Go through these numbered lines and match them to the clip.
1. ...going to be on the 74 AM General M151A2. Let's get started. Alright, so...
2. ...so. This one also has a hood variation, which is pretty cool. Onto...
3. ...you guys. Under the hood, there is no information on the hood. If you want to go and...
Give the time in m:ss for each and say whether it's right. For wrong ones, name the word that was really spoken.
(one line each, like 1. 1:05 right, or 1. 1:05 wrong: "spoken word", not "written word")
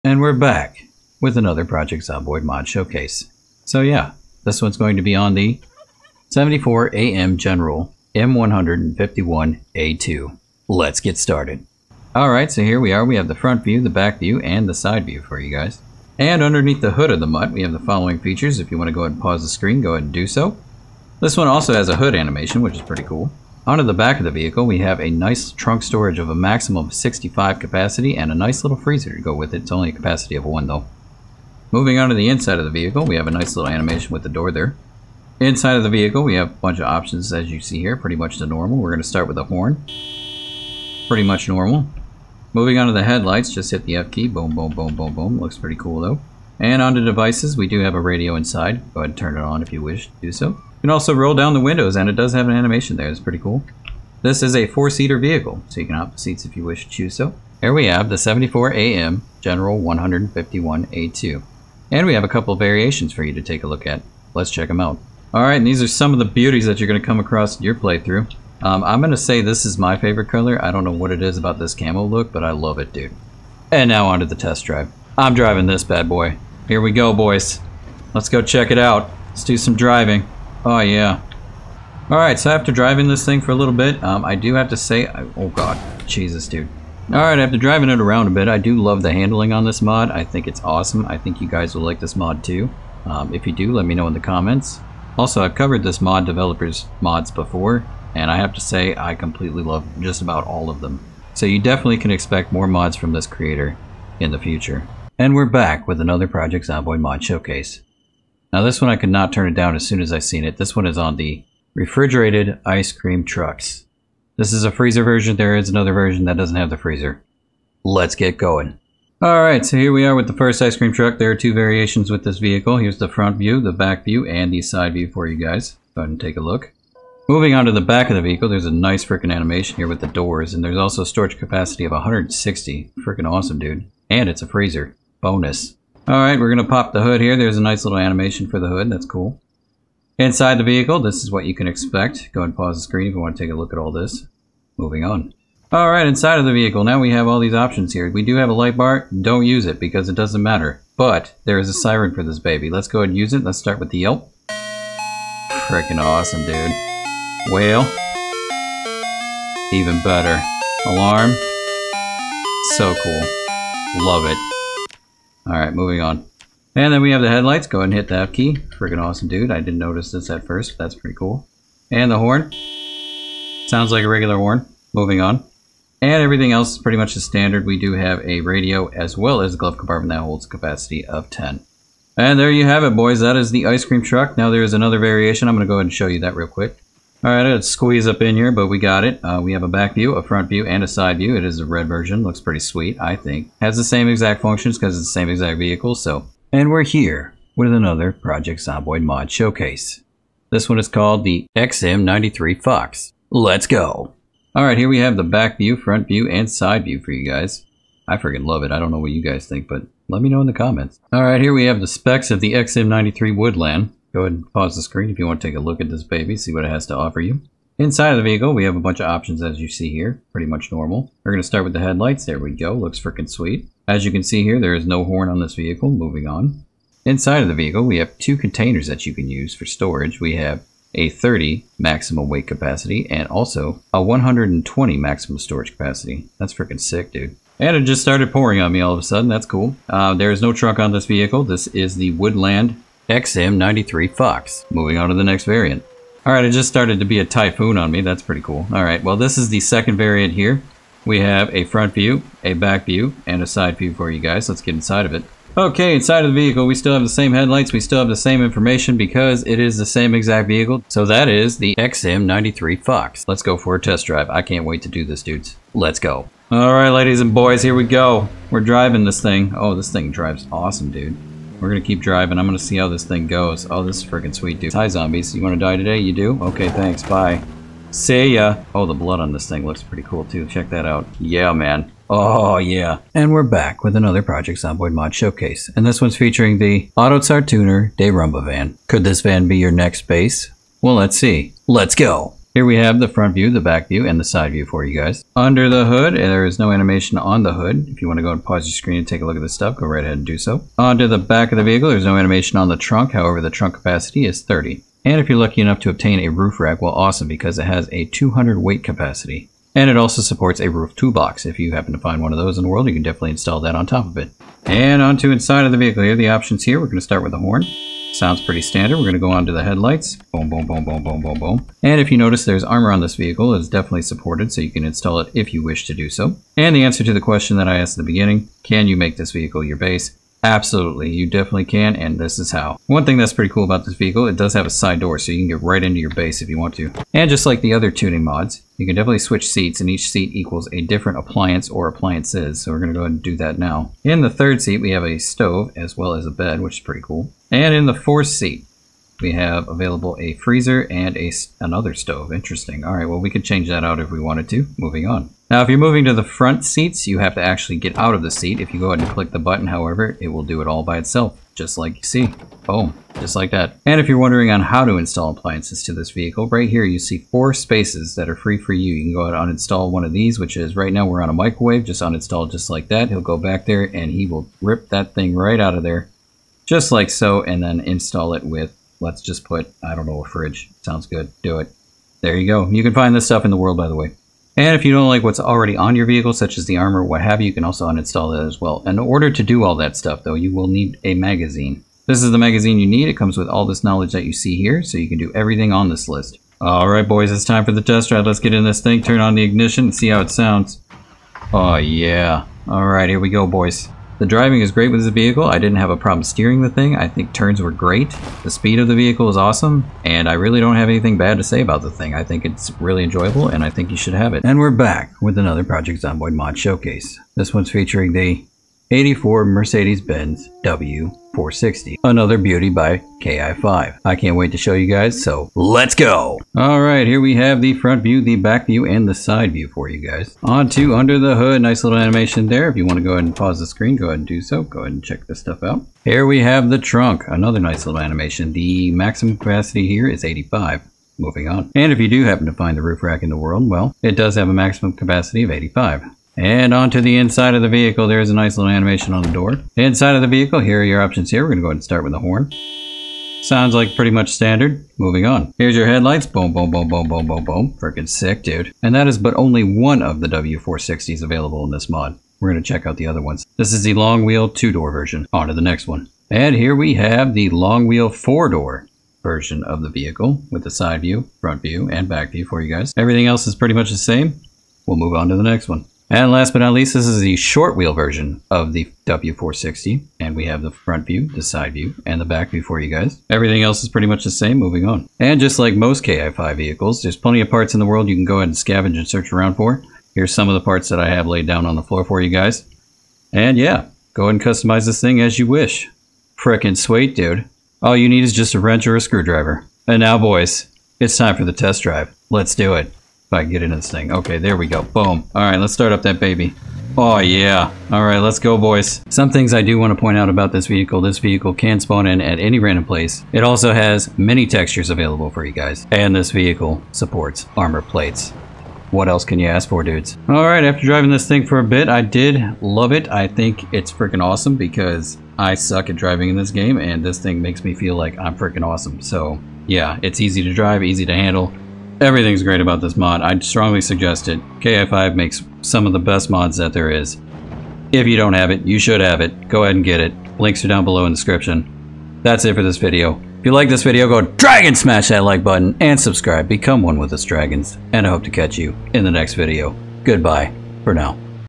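1. 0:04 right
2. 0:20 wrong: "animation", not "variation"
3. 4:54 wrong: "animation", not "information".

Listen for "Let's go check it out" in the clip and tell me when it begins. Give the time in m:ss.
1:18.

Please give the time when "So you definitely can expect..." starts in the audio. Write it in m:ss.
1:41.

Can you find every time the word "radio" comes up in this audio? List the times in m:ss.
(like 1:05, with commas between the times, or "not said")
0:47, 2:58.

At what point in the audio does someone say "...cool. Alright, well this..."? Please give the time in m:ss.
4:08.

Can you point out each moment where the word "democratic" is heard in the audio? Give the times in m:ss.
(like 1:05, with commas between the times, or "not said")
not said.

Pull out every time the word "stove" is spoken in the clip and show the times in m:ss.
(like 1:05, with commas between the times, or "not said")
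5:45, 5:51.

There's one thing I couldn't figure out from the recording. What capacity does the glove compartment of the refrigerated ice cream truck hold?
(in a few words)
10.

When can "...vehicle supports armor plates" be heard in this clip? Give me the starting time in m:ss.
8:36.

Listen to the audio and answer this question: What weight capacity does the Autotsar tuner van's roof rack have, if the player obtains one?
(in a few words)
200.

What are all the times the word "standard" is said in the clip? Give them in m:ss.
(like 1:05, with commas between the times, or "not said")
2:57, 5:18, 7:34.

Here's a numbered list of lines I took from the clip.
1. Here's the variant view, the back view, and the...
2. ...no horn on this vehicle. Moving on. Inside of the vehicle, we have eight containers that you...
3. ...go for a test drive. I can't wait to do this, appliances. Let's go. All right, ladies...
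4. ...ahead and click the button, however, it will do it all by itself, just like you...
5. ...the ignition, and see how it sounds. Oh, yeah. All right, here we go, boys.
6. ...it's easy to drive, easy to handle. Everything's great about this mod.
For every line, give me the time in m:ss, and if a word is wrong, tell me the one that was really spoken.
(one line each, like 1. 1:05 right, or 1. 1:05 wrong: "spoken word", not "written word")
1. 2:02 wrong: "front", not "variant"
2. 3:44 wrong: "two", not "eight"
3. 4:23 wrong: "dudes", not "appliances"
4. 5:58 right
5. 6:39 right
6. 8:50 right.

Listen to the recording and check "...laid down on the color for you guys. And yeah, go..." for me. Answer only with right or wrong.
wrong.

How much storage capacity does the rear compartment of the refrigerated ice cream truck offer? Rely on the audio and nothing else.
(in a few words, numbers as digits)
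160.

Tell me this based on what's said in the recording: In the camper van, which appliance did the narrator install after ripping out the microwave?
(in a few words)
A fridge.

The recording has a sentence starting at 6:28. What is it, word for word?
In order to do all that stuff, though, you will need a magazine.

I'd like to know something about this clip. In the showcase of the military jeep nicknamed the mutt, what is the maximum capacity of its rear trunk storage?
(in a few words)
65.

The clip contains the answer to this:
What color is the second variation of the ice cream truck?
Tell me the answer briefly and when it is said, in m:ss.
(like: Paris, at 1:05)
Red, at 3:11.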